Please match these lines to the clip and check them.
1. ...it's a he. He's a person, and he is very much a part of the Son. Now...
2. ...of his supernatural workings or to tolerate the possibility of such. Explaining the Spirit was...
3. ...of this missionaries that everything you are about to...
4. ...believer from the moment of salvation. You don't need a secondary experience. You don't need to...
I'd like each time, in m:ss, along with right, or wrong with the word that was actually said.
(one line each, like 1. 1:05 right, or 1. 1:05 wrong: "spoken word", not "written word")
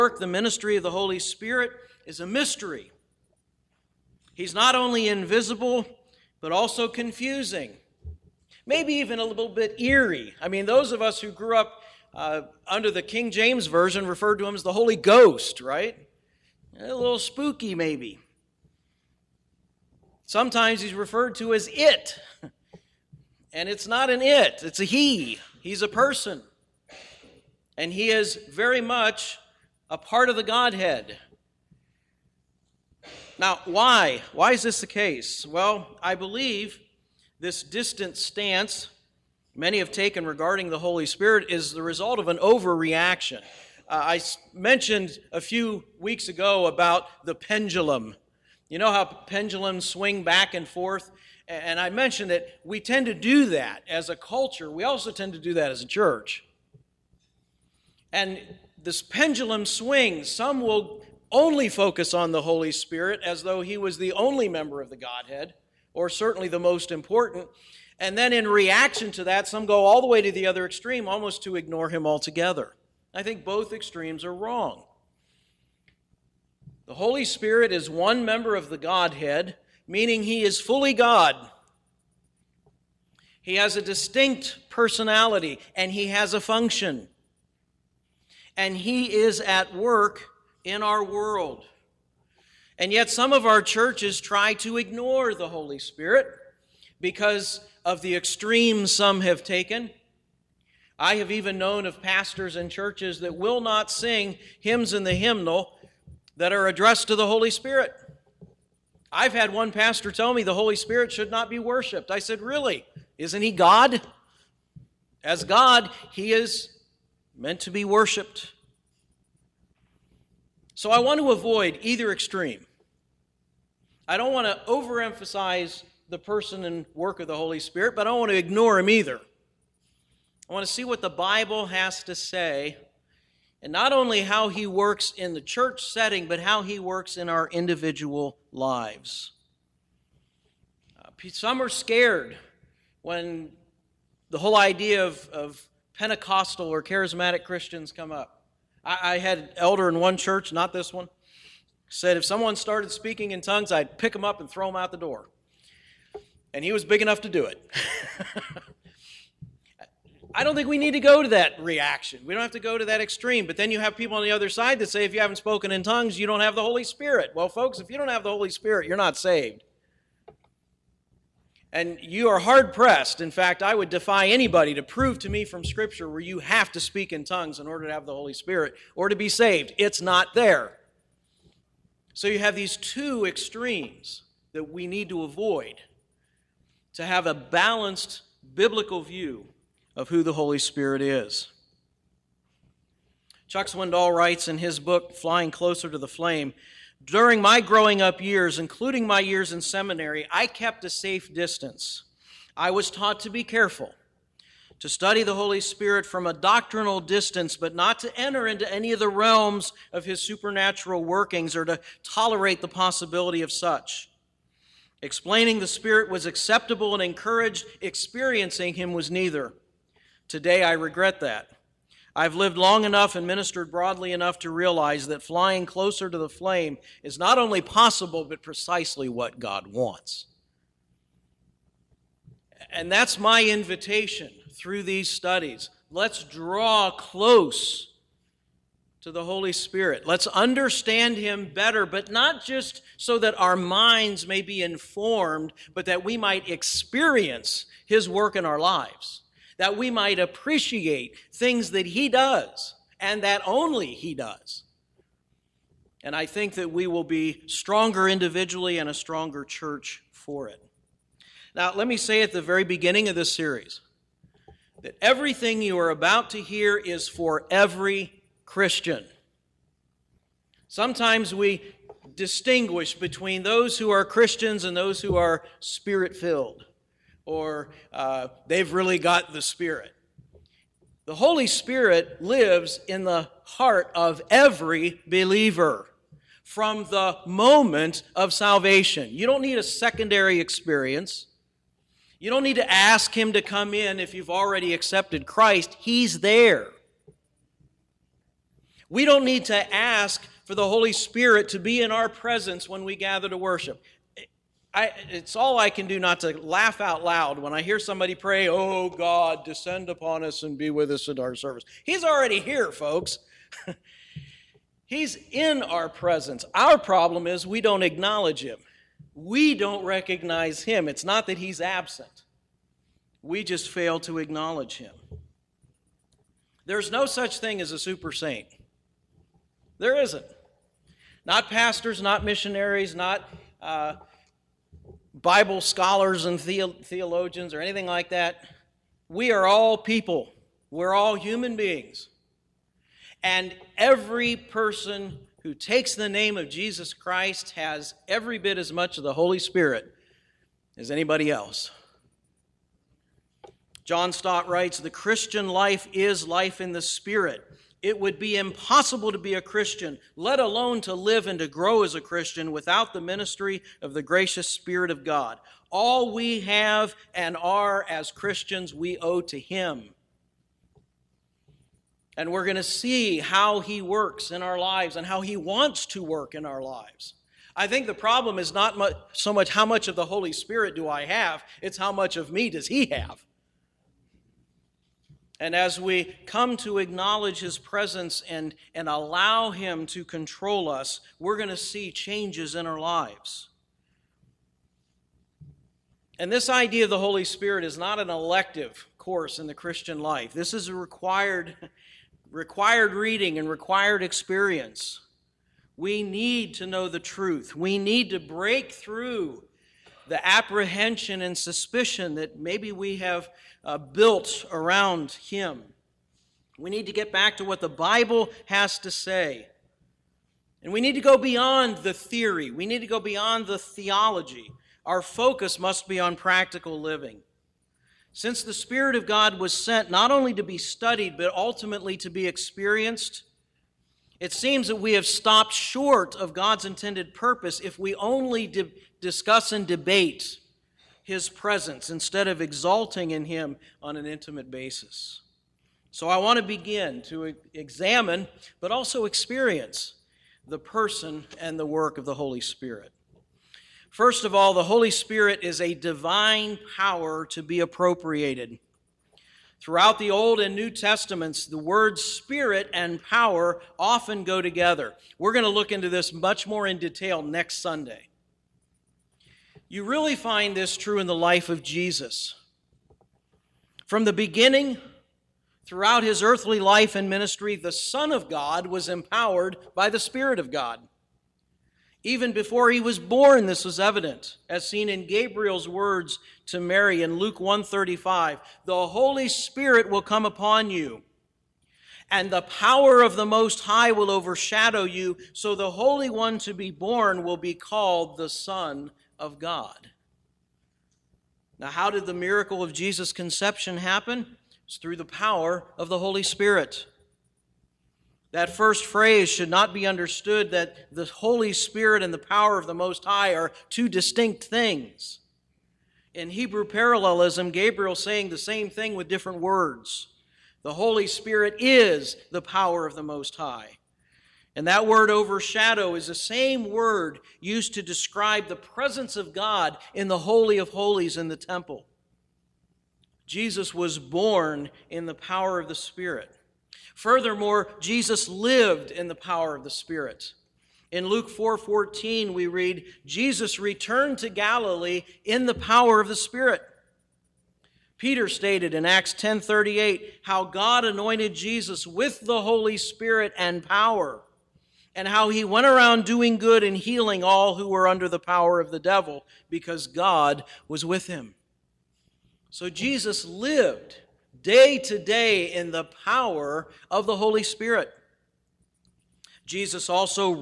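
1. 0:24 wrong: "Godhead", not "Son"
2. 3:29 right
3. 4:23 wrong: "series", not "missionaries"
4. 4:45 right.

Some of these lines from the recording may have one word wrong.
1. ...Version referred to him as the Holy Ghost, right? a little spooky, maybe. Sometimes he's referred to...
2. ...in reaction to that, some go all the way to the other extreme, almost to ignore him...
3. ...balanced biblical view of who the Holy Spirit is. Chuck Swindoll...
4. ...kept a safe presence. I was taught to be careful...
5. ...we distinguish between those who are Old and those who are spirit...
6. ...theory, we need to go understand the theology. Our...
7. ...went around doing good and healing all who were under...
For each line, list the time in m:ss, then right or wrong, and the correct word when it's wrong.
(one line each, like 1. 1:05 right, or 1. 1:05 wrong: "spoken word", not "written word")
1. 0:13 right
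2. 1:08 right
3. 3:07 right
4. 3:20 wrong: "distance", not "presence"
5. 4:31 wrong: "Christians", not "Old"
6. 7:01 wrong: "beyond", not "understand"
7. 9:15 right.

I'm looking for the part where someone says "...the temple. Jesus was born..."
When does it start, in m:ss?
8:51.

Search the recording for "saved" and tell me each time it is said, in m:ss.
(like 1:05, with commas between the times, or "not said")
2:49, 2:59.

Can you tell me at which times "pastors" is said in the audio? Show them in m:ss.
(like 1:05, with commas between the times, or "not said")
1:42, 1:49, 5:31.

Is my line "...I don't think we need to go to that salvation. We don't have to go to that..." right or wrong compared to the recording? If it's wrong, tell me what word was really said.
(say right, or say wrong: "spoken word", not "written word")
wrong: "reaction", not "salvation".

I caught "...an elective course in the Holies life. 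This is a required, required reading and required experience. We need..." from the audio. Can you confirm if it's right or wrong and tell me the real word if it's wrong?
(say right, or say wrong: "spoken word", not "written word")
wrong: "Christian", not "Holies".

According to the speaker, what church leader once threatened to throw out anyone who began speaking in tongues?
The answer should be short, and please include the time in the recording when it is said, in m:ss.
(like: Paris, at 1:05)
An elder, at 2:29.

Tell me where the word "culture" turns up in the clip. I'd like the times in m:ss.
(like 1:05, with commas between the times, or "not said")
0:54.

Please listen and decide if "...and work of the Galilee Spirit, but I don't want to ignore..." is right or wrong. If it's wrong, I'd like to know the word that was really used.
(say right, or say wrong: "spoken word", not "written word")
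wrong: "Holy", not "Galilee".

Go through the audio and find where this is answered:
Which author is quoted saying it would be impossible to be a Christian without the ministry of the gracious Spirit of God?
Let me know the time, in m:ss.
5:53.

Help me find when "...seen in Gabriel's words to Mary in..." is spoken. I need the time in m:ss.
8:04.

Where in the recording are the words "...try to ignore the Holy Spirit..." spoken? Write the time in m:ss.
1:34.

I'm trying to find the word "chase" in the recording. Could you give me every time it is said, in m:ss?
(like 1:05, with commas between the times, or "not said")
not said.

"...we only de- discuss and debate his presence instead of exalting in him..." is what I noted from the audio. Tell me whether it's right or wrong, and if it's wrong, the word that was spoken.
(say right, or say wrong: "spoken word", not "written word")
right.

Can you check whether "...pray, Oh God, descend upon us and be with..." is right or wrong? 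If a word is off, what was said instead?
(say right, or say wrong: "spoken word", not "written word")
right.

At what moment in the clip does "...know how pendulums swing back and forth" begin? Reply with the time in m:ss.
0:48.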